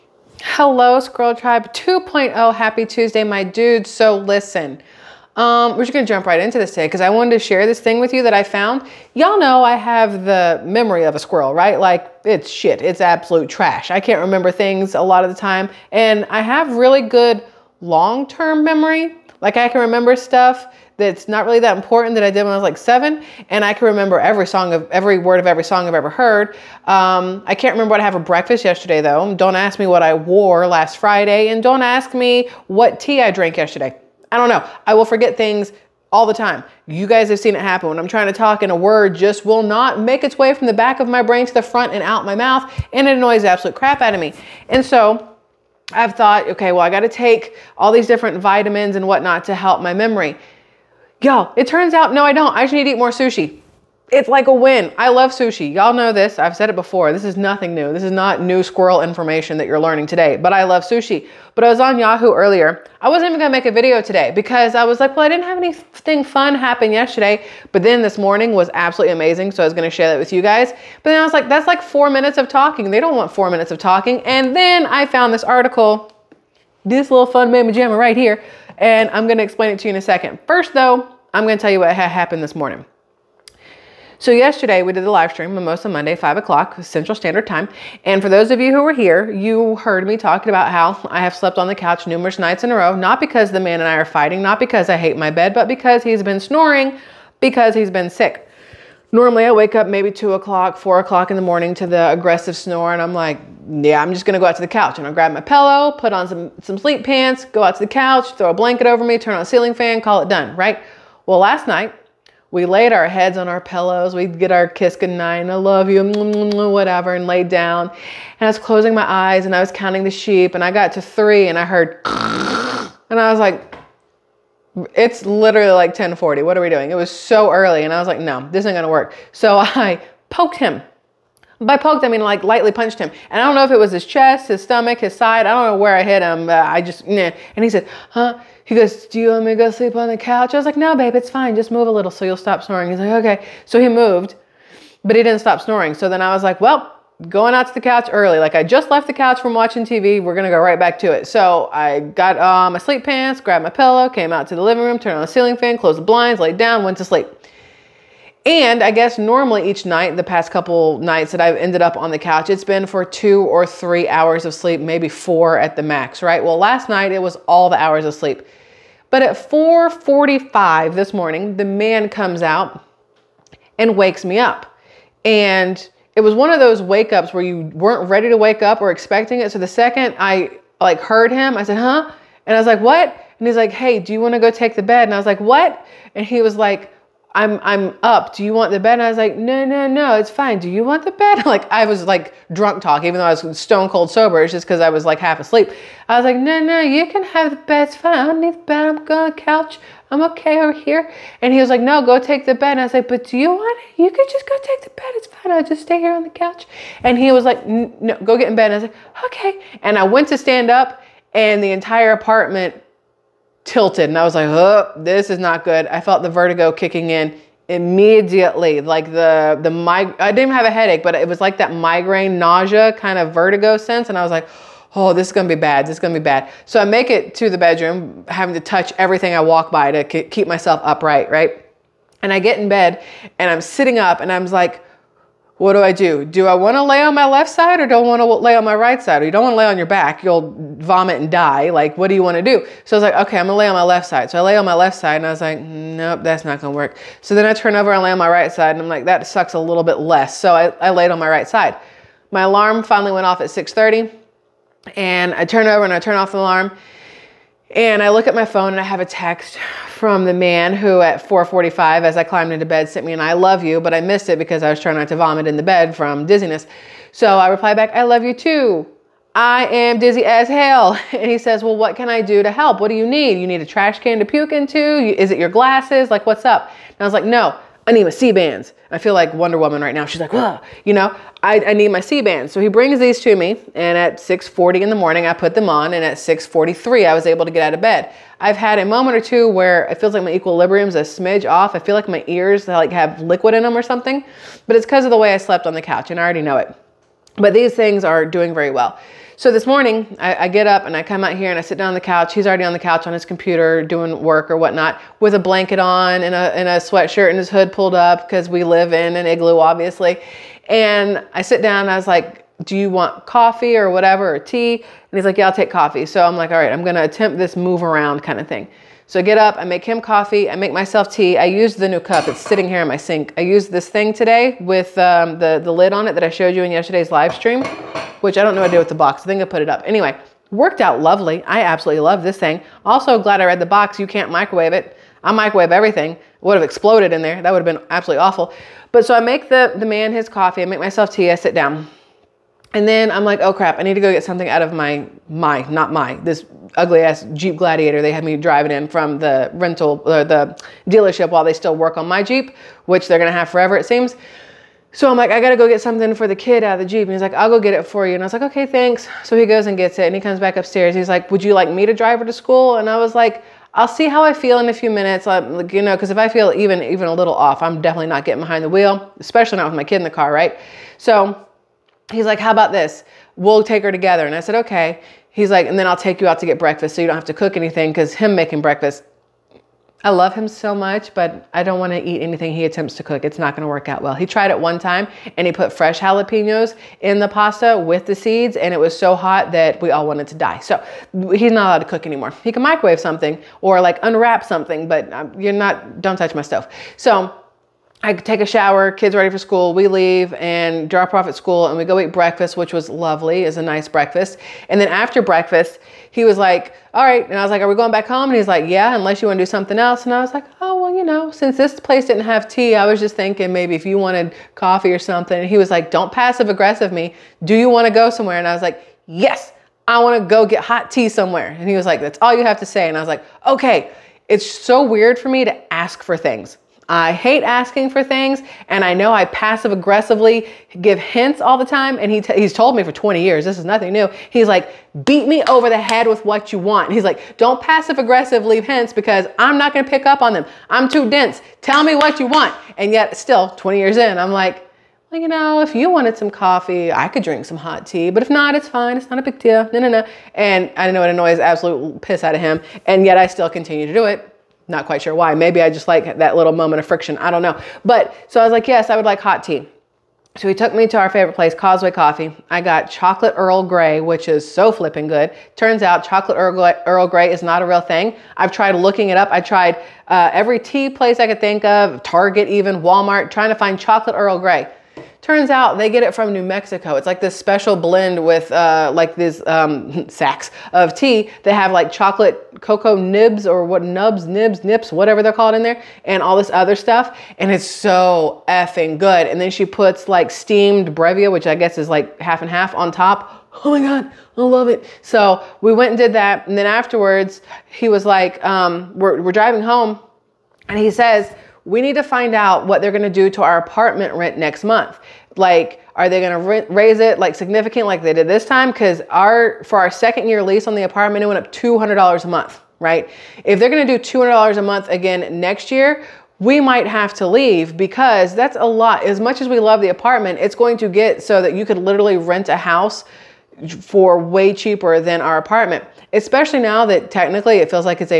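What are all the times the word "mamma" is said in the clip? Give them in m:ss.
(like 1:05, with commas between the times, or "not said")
1:17.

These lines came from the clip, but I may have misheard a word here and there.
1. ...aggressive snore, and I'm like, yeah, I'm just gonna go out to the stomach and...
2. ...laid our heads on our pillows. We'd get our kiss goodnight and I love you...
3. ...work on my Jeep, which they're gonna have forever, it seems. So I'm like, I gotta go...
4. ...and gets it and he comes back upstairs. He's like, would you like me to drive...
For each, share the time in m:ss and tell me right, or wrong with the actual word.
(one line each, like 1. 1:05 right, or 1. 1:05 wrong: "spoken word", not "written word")
1. 1:42 wrong: "couch", not "stomach"
2. 1:52 right
3. 5:51 right
4. 5:59 right.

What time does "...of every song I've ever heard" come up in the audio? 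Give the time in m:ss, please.
0:25.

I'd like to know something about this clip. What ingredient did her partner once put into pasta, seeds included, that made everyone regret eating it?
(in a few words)
jalapenos.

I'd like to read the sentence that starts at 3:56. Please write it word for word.
Do I want to lay on my left side or don't want to lay on my right side?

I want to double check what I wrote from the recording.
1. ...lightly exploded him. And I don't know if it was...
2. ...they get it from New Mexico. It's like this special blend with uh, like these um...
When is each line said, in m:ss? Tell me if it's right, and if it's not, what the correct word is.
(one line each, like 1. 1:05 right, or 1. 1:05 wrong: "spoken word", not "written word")
1. 2:12 wrong: "punched", not "exploded"
2. 7:55 right.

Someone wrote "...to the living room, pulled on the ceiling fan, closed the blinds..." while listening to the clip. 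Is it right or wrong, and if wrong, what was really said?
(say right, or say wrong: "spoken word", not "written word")
wrong: "turned", not "pulled".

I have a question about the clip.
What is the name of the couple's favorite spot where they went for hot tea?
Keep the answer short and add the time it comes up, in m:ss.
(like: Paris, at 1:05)
Causeway Coffee, at 7:41.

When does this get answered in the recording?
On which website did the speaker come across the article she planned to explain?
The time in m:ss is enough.
1:01.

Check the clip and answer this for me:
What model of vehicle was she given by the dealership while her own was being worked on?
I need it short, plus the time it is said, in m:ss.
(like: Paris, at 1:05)
Jeep Gladiator, at 5:47.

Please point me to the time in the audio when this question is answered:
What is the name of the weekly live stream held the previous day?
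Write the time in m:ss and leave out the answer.
1:25.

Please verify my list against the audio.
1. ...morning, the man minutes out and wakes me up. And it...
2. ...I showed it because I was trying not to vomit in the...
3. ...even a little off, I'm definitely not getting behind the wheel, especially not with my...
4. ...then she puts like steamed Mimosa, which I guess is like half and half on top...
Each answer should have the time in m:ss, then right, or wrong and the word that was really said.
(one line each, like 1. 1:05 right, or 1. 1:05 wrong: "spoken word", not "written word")
1. 2:51 wrong: "comes", not "minutes"
2. 4:23 wrong: "missed", not "showed"
3. 6:06 right
4. 8:09 wrong: "Brevia", not "Mimosa".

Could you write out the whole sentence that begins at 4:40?
She's like, whoa, you know, I, I need my Sea-Bands.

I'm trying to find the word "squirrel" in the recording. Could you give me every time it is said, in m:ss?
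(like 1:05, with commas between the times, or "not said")
0:00, 0:11, 0:58.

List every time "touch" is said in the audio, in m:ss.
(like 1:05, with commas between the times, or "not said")
3:48, 6:36.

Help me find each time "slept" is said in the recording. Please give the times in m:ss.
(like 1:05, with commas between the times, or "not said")
1:31, 4:55.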